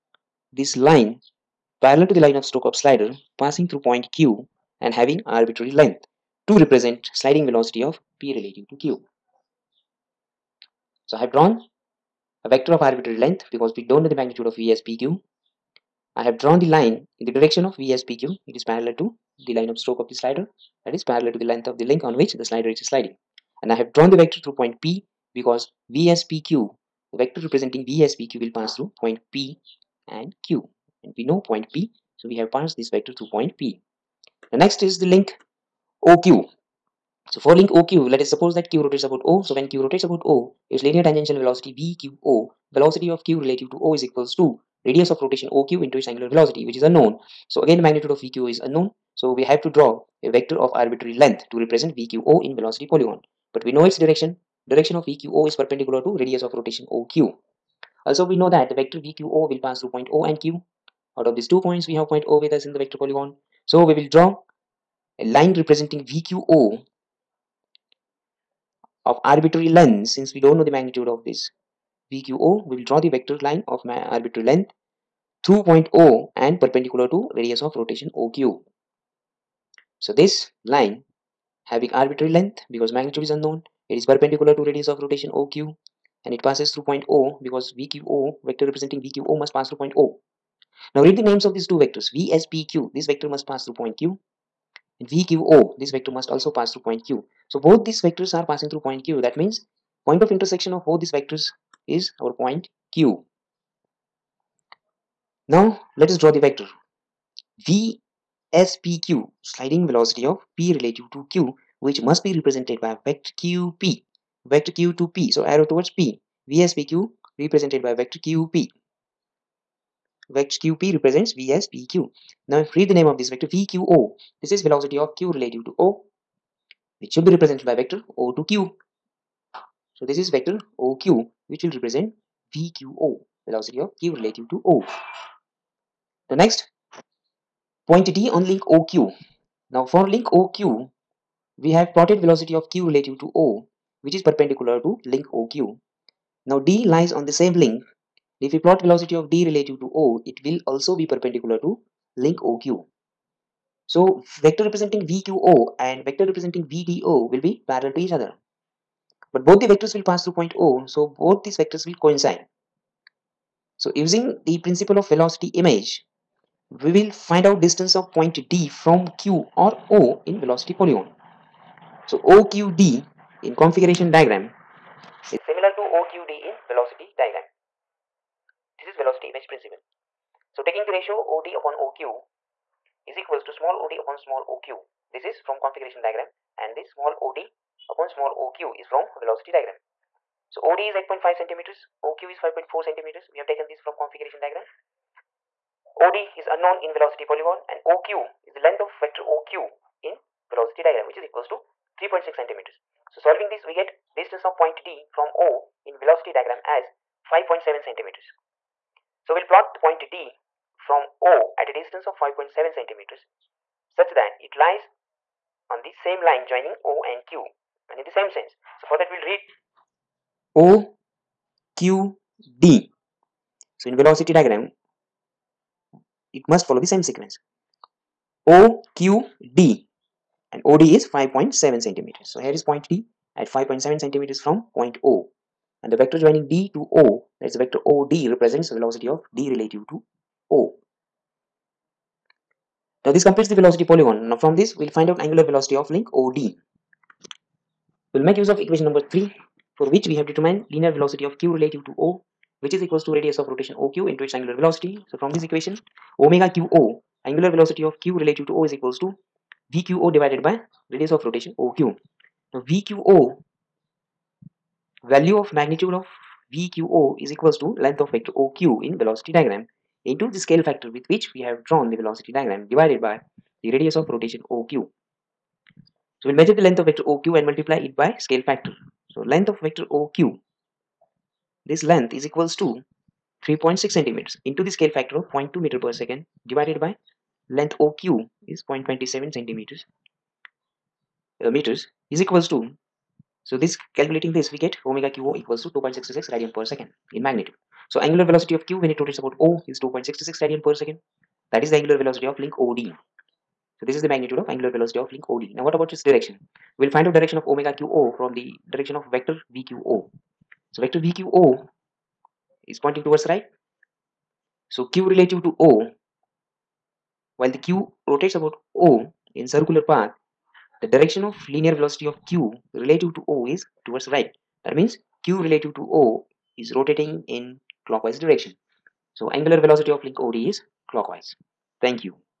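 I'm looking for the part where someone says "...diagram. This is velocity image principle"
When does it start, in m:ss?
2:57.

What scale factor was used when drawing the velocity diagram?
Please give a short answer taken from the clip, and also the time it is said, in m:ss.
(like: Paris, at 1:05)
0.2 meter per second, at 4:45.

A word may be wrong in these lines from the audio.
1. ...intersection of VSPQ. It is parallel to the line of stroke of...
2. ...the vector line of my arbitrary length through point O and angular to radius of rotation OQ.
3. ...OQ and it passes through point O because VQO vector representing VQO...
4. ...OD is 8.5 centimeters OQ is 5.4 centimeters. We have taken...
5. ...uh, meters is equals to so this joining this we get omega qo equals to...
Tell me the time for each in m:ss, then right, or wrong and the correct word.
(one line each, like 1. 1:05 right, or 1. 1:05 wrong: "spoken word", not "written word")
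1. 0:17 wrong: "direction", not "intersection"
2. 1:12 wrong: "perpendicular", not "angular"
3. 1:25 right
4. 3:10 right
5. 4:51 wrong: "calculating", not "joining".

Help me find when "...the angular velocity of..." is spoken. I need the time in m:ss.
5:01.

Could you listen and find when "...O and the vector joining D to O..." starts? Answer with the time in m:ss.
3:55.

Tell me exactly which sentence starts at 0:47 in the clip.
So again, the magnitude of VQ is unknown.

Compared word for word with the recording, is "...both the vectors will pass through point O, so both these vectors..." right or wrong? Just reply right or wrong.
right.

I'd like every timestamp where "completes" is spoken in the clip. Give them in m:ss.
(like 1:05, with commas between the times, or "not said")
4:03.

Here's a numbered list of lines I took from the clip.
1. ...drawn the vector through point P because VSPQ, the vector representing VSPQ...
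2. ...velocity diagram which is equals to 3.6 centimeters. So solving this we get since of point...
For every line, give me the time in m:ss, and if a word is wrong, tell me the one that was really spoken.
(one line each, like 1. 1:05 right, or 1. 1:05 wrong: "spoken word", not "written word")
1. 0:23 right
2. 3:20 wrong: "distance", not "since".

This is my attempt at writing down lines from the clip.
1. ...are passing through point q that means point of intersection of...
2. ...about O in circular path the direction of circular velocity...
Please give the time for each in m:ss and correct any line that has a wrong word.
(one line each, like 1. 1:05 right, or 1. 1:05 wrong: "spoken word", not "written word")
1. 1:38 right
2. 5:18 wrong: "linear", not "circular".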